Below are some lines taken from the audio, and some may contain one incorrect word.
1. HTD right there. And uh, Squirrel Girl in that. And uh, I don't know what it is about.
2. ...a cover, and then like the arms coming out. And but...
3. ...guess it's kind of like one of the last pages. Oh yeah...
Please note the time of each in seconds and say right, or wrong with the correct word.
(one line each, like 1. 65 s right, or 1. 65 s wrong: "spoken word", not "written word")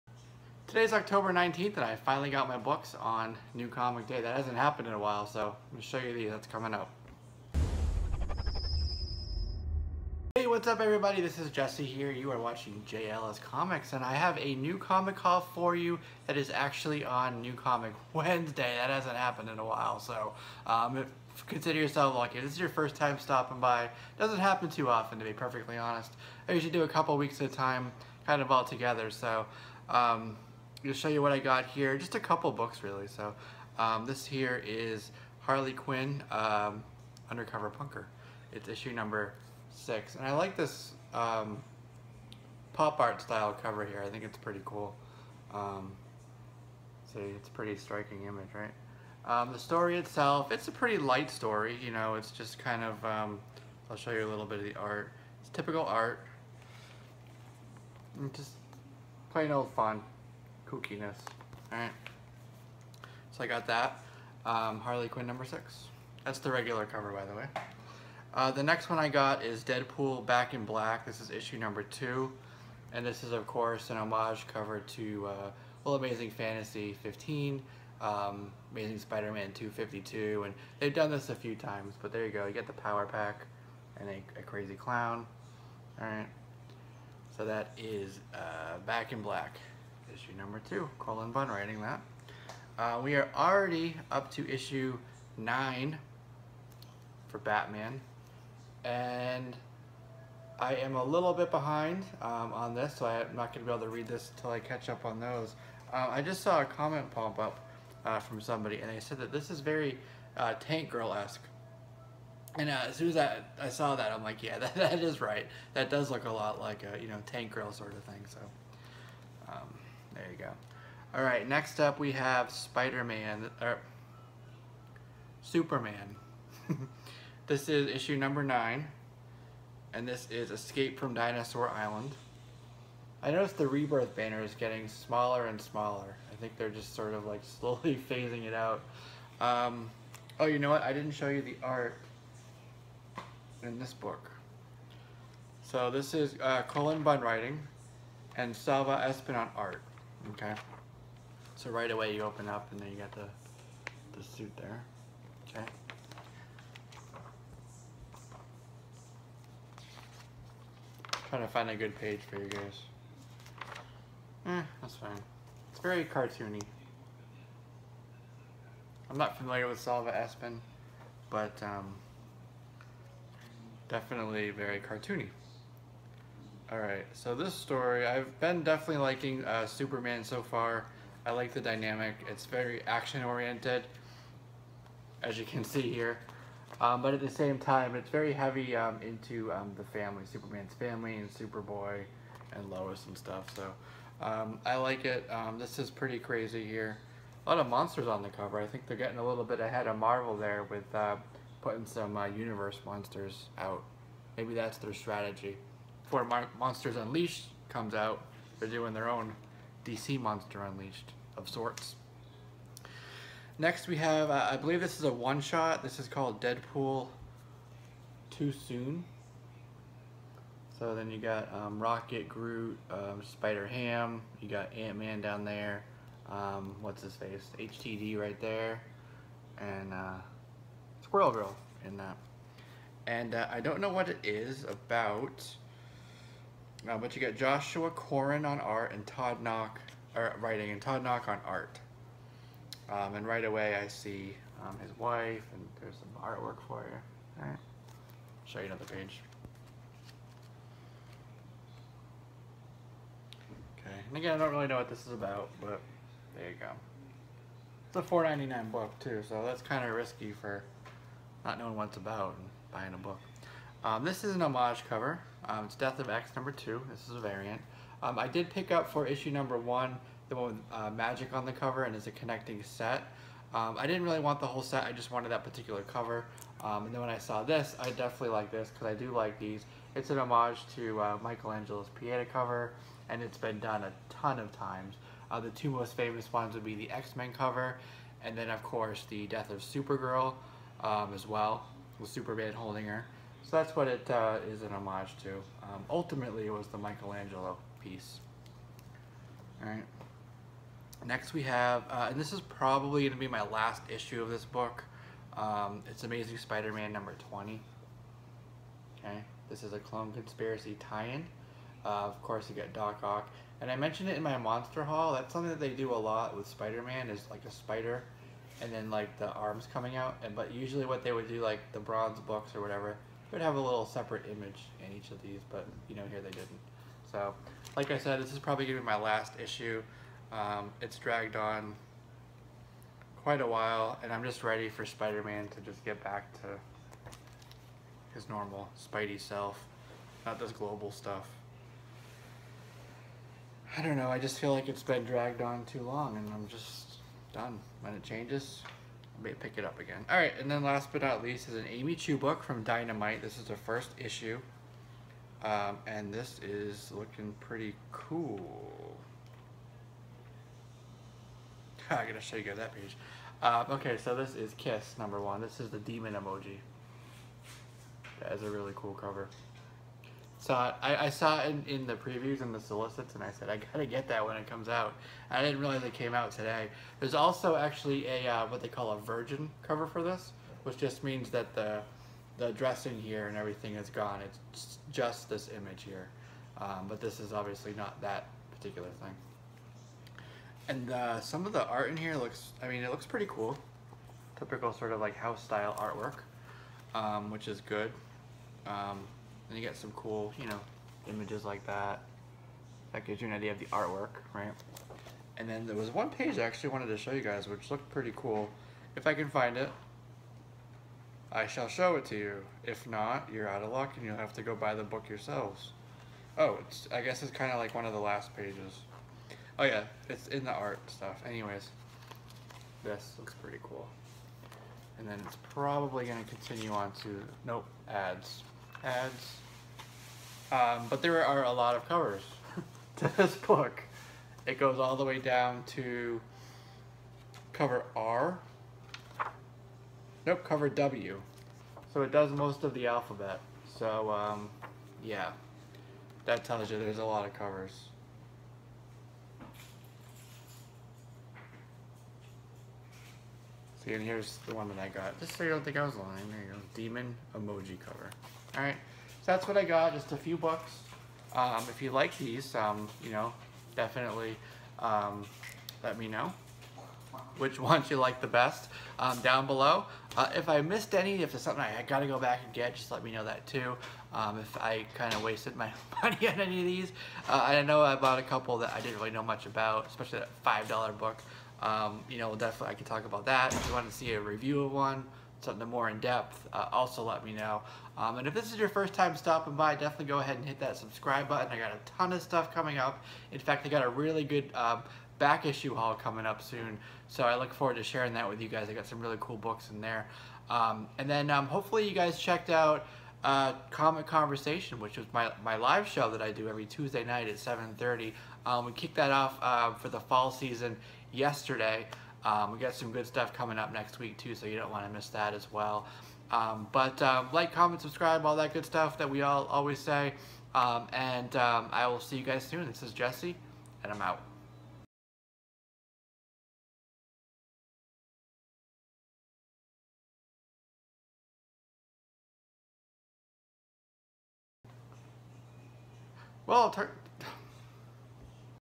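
1. 227 s right
2. 317 s wrong: "spider", not "cover"
3. 417 s right.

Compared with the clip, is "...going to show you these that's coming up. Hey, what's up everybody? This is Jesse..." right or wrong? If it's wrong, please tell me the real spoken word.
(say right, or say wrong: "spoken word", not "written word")
right.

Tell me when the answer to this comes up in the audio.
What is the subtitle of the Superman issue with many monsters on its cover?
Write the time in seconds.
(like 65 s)
130 s.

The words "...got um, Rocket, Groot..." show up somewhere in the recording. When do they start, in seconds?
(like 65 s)
221 s.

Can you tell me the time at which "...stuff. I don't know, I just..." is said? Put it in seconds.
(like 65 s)
340 s.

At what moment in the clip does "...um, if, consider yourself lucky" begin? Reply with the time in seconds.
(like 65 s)
20 s.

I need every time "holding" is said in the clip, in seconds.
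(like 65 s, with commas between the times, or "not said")
292 s.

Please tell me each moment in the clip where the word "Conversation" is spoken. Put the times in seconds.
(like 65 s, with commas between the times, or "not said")
504 s.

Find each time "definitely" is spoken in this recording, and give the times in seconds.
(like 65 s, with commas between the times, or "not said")
173 s, 178 s, 277 s, 463 s, 482 s, 489 s.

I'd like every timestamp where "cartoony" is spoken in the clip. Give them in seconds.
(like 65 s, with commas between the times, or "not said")
166 s, 174 s.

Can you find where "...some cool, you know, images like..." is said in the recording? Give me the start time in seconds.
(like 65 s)
399 s.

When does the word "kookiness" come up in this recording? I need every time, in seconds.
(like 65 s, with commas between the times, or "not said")
60 s.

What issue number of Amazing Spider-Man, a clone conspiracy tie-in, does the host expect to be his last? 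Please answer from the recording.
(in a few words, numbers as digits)
20.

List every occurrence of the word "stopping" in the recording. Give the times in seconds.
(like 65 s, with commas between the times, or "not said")
23 s, 489 s.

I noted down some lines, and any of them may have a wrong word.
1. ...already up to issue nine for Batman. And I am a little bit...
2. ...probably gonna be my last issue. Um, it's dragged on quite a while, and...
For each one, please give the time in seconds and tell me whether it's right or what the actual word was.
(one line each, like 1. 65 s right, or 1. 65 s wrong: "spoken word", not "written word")
1. 93 s right
2. 328 s right.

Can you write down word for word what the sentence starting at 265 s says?
Um, it's Death of X number two.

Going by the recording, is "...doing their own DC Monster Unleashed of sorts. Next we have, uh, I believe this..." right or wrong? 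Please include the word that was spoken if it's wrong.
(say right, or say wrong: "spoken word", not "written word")
right.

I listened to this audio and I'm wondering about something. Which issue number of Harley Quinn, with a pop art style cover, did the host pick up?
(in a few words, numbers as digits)
6.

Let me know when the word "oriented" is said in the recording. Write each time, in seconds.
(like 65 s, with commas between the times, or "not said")
182 s.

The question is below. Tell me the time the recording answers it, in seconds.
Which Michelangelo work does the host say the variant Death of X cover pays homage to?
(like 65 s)
281 s.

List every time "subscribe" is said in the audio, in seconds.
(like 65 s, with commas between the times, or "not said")
490 s, 517 s.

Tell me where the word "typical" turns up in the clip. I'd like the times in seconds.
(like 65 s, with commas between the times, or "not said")
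55 s, 394 s.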